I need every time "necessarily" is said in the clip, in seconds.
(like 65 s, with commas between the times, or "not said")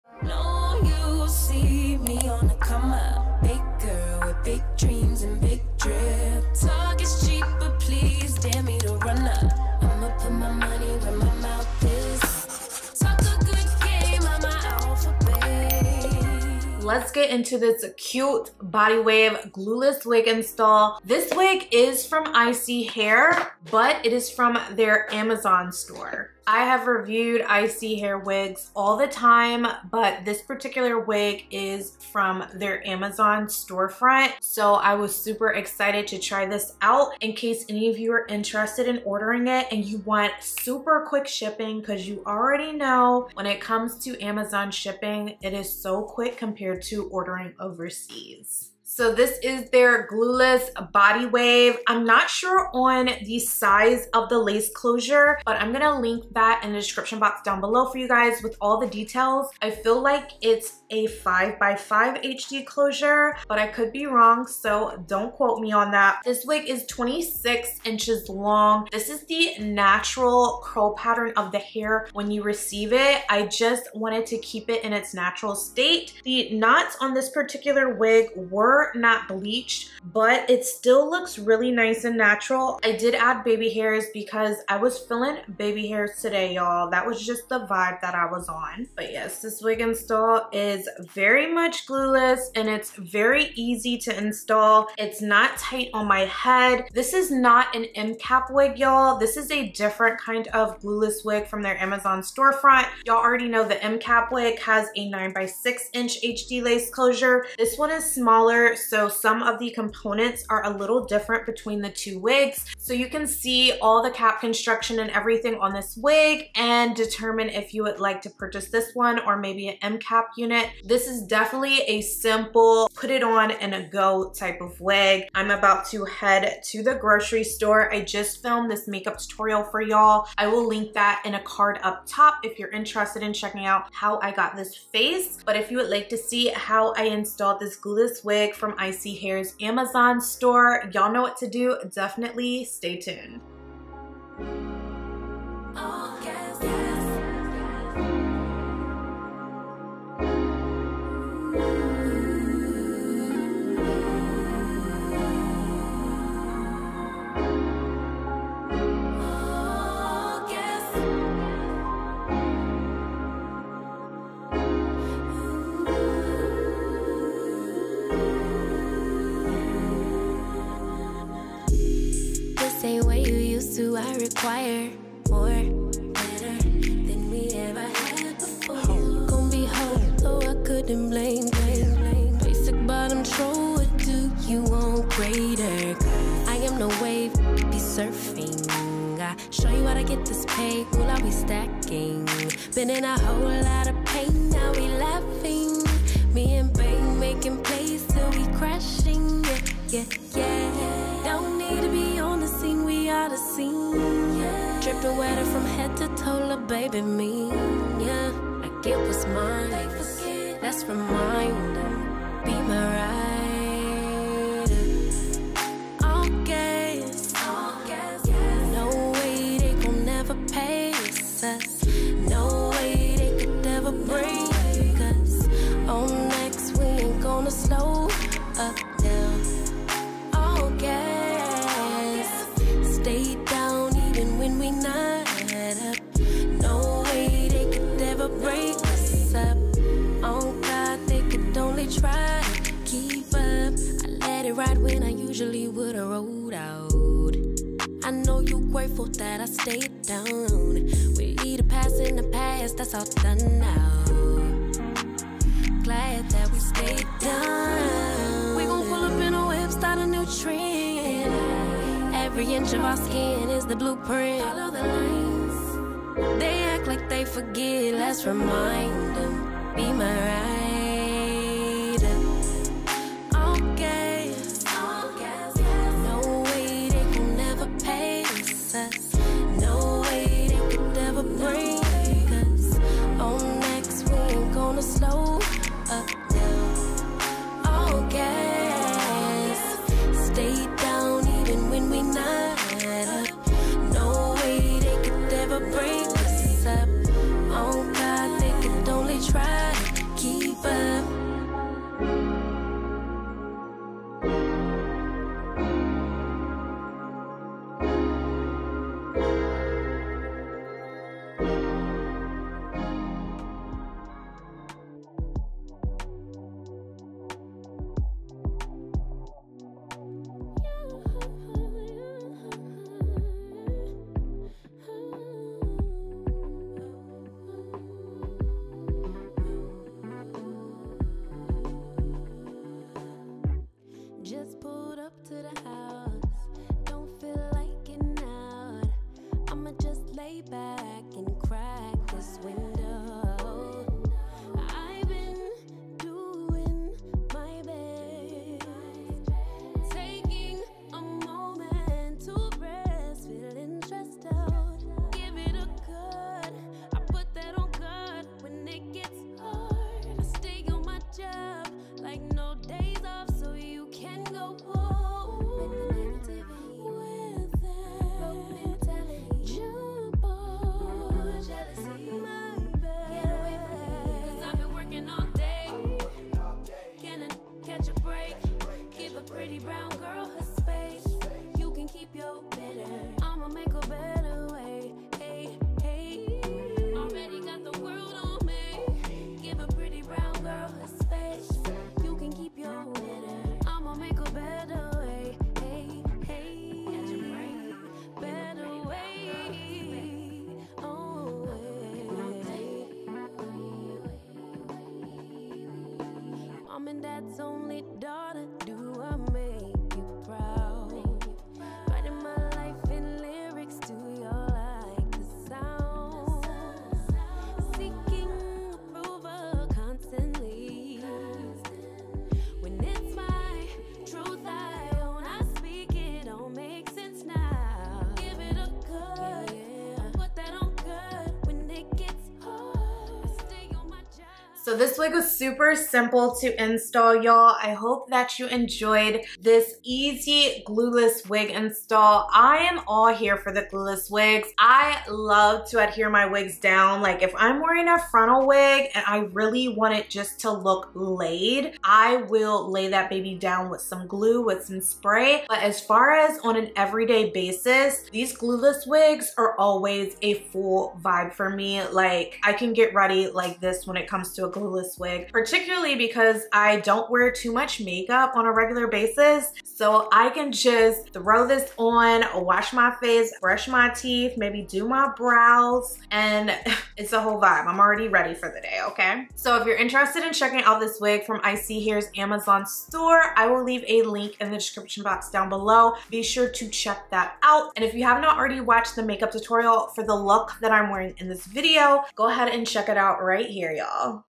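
not said.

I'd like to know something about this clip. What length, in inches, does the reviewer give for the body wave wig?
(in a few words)
26 inches.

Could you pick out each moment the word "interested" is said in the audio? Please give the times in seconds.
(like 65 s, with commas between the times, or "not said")
38 s, 132 s, 479 s.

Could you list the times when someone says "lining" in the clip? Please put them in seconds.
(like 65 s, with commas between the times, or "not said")
not said.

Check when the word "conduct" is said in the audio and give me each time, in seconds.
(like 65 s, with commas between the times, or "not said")
not said.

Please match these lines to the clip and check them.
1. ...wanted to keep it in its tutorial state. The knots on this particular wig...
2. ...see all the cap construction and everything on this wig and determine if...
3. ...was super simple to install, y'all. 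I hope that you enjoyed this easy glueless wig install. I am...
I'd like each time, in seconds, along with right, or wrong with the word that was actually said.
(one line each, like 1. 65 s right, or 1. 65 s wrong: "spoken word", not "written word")
1. 73 s wrong: "natural", not "tutorial"
2. 113 s right
3. 435 s right.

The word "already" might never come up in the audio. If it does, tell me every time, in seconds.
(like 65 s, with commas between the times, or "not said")
42 s, 103 s, 477 s, 488 s.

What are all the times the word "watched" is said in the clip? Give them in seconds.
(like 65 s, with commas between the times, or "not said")
488 s.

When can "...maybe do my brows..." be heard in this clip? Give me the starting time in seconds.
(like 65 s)
474 s.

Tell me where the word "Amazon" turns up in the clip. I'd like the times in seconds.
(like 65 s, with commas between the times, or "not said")
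25 s, 32 s, 44 s, 101 s, 139 s, 482 s.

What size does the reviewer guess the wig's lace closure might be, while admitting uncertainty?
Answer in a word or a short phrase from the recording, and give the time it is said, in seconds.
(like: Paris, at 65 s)
5 by 5, at 61 s.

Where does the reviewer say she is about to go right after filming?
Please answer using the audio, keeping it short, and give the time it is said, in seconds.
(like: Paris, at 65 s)
grocery store, at 126 s.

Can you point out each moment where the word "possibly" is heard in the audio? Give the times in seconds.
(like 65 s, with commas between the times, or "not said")
not said.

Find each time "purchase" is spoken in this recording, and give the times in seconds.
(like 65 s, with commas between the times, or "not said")
118 s.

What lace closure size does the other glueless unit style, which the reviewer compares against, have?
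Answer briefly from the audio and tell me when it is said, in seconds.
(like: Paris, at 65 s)
9 by 6 inches, at 105 s.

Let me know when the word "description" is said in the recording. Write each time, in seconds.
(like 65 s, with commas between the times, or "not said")
56 s, 484 s.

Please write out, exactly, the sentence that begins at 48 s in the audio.
So this is their glueless body wave.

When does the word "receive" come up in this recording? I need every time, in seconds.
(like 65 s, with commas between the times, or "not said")
72 s.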